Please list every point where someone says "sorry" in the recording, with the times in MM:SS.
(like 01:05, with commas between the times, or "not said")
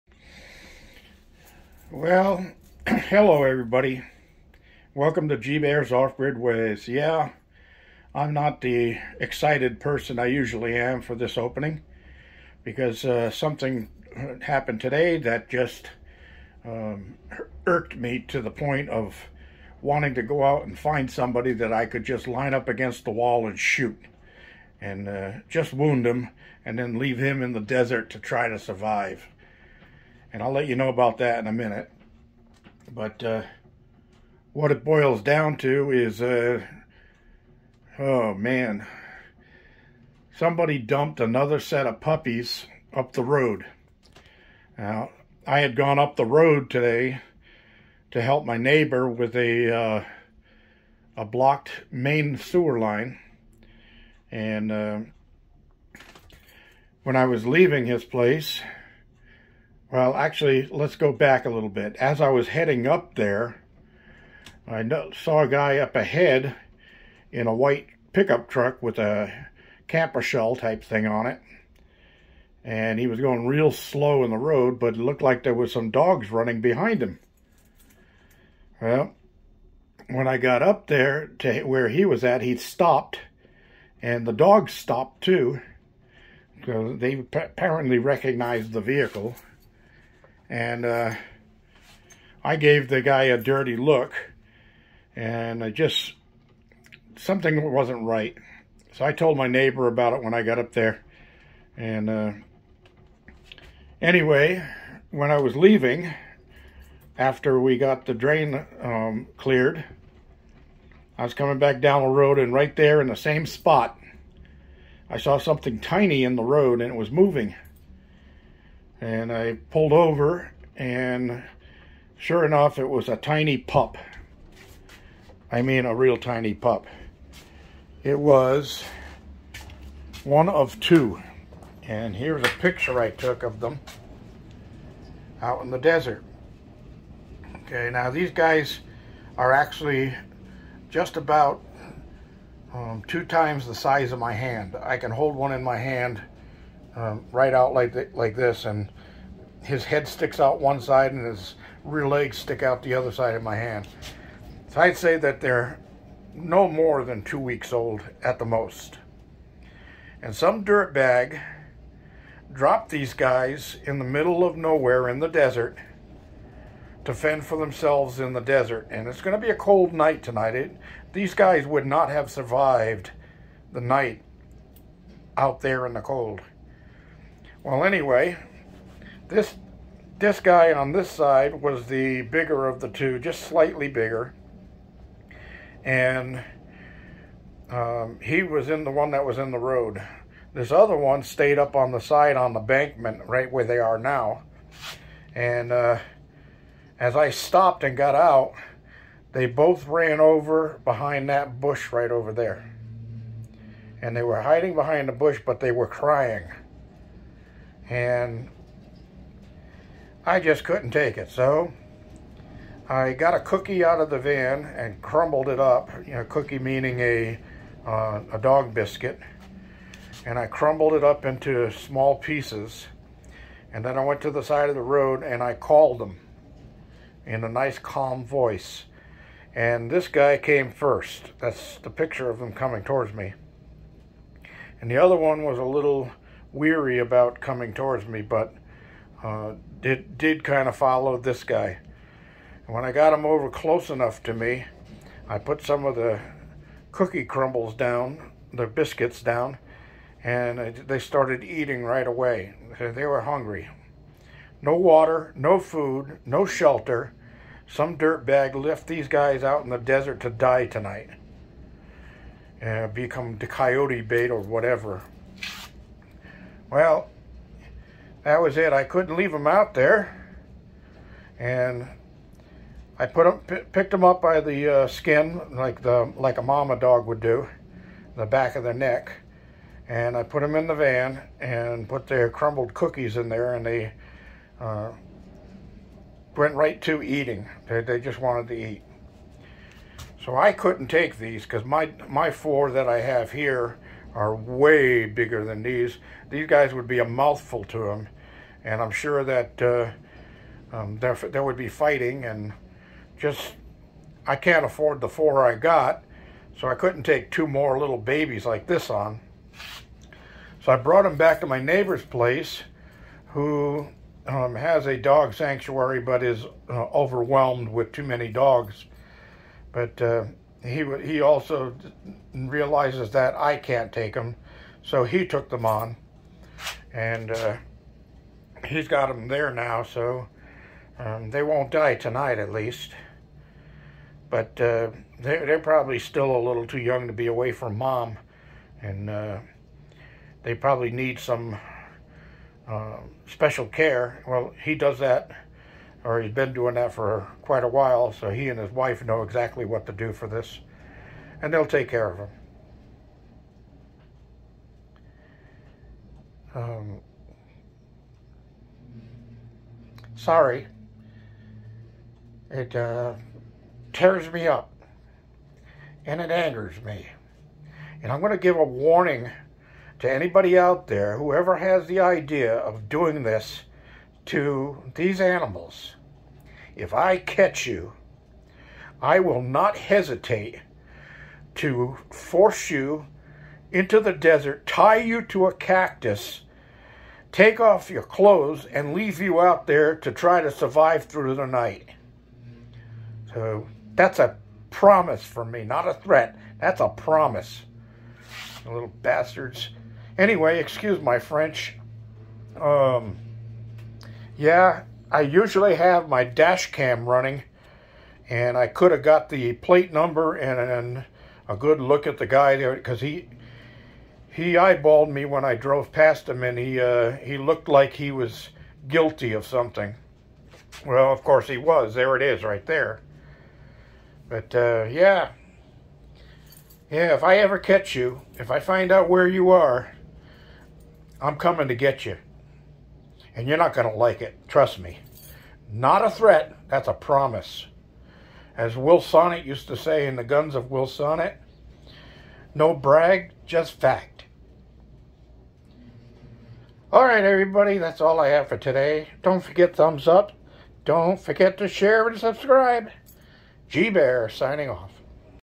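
06:00.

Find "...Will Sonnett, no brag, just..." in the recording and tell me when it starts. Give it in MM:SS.
07:20.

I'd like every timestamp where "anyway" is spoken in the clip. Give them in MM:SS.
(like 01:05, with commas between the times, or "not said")
01:44, 02:57, 06:40.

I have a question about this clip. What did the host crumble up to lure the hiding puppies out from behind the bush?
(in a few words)
A dog biscuit.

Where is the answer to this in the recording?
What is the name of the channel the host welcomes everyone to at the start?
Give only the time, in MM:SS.
00:05.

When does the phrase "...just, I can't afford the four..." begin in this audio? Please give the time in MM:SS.
05:03.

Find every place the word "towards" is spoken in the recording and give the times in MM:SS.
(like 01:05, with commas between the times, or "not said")
03:52, 03:57.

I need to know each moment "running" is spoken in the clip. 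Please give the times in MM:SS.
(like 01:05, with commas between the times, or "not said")
01:16, 06:47.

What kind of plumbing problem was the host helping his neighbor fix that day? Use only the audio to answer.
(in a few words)
Blocked main sewer line.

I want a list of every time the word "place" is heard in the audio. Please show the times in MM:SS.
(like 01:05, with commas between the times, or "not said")
00:58, 05:12.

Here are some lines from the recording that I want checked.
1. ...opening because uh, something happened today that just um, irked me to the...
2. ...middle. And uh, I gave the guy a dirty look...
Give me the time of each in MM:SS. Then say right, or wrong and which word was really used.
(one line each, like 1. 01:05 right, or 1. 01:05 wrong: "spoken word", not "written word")
1. 00:11 right
2. 01:28 wrong: "vehicle", not "middle".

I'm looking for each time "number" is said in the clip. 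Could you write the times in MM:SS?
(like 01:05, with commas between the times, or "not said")
06:49.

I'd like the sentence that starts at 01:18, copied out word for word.
Well, when I got up there to where he was at, he stopped, and the dogs stopped too.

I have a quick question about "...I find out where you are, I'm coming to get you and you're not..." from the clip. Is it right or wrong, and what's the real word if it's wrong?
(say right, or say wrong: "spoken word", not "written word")
right.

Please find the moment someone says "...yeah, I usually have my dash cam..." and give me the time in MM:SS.
06:44.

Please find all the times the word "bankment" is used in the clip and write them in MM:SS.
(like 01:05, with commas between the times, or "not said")
03:12.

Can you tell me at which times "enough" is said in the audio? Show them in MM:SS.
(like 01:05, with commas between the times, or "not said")
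02:02, 04:03.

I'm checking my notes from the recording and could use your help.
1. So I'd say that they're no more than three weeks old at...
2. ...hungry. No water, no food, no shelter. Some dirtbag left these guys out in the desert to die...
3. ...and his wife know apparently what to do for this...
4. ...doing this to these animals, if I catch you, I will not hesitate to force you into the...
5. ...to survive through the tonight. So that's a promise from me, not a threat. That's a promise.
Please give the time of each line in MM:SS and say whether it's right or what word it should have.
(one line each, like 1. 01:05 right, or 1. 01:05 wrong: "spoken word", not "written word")
1. 02:34 wrong: "two", not "three"
2. 04:13 right
3. 05:48 wrong: "exactly", not "apparently"
4. 06:12 right
5. 06:30 wrong: "night", not "tonight".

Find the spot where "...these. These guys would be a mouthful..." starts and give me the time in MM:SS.
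04:55.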